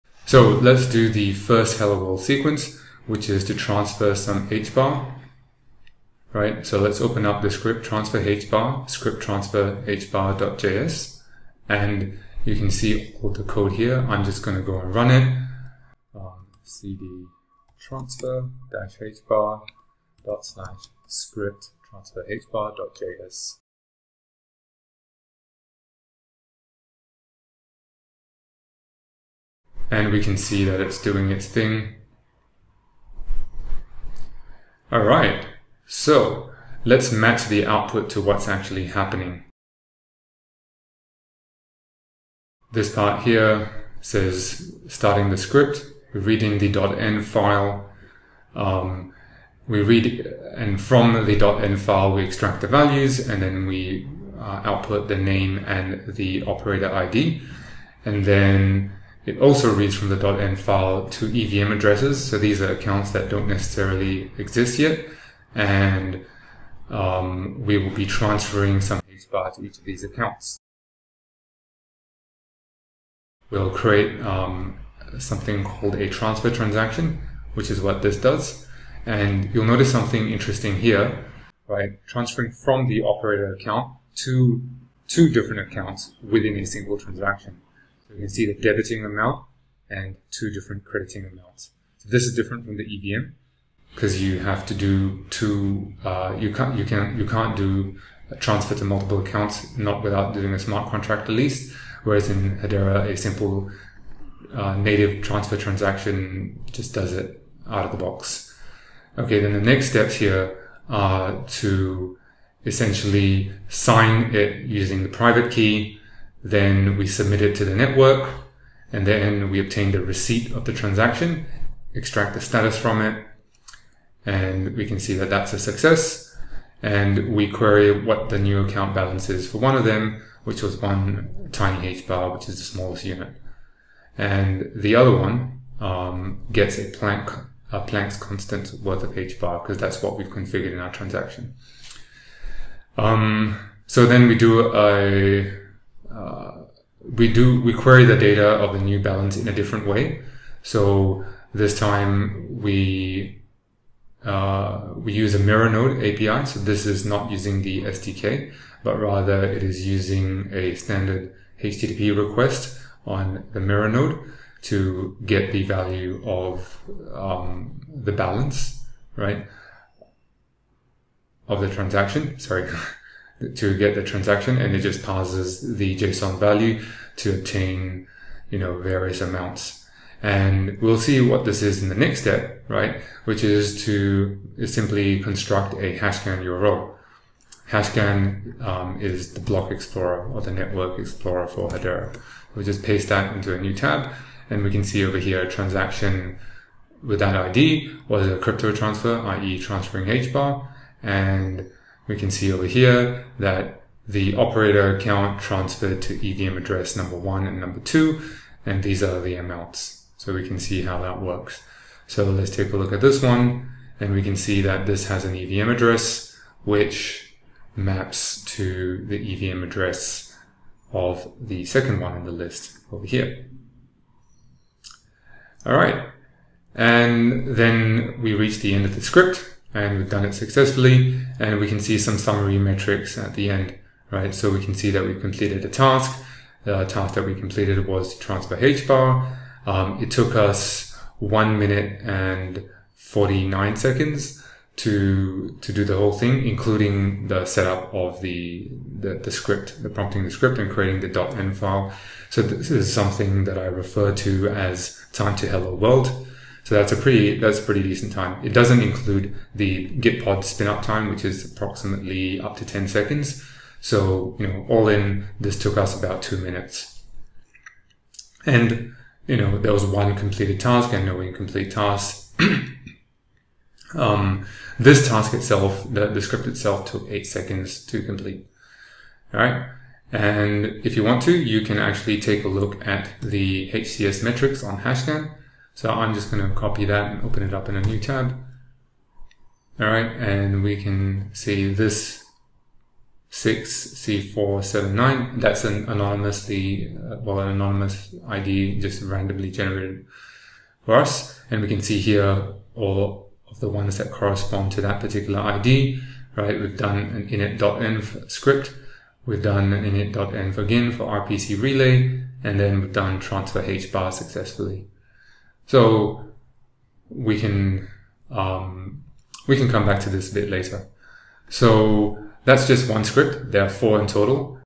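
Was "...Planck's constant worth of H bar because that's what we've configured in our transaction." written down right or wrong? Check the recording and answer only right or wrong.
right.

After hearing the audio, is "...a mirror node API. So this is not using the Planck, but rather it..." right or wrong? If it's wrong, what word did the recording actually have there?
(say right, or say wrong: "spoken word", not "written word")
wrong: "SDK", not "Planck".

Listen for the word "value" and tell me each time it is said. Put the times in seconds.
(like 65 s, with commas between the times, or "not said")
52 s, 165 s, 176 s.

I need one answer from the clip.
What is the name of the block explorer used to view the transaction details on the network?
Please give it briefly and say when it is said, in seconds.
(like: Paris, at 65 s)
HashScan, at 187 s.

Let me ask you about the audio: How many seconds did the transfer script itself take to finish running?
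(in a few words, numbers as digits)
8 seconds.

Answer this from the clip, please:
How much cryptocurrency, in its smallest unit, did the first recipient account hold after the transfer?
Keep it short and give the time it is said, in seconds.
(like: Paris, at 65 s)
1 tiny hbar, at 130 s.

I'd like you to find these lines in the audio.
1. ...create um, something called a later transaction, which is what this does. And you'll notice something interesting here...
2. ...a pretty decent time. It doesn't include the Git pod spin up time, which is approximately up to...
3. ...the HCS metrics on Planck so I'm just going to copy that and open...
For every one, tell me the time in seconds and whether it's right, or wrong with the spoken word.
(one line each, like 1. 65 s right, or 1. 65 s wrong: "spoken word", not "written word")
1. 73 s wrong: "transfer", not "later"
2. 257 s right
3. 283 s wrong: "Hashcan", not "Planck".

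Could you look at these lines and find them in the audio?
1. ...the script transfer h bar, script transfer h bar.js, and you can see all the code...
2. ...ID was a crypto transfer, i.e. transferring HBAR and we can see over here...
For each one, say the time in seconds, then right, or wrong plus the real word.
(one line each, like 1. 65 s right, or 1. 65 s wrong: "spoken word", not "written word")
1. 7 s right
2. 197 s right.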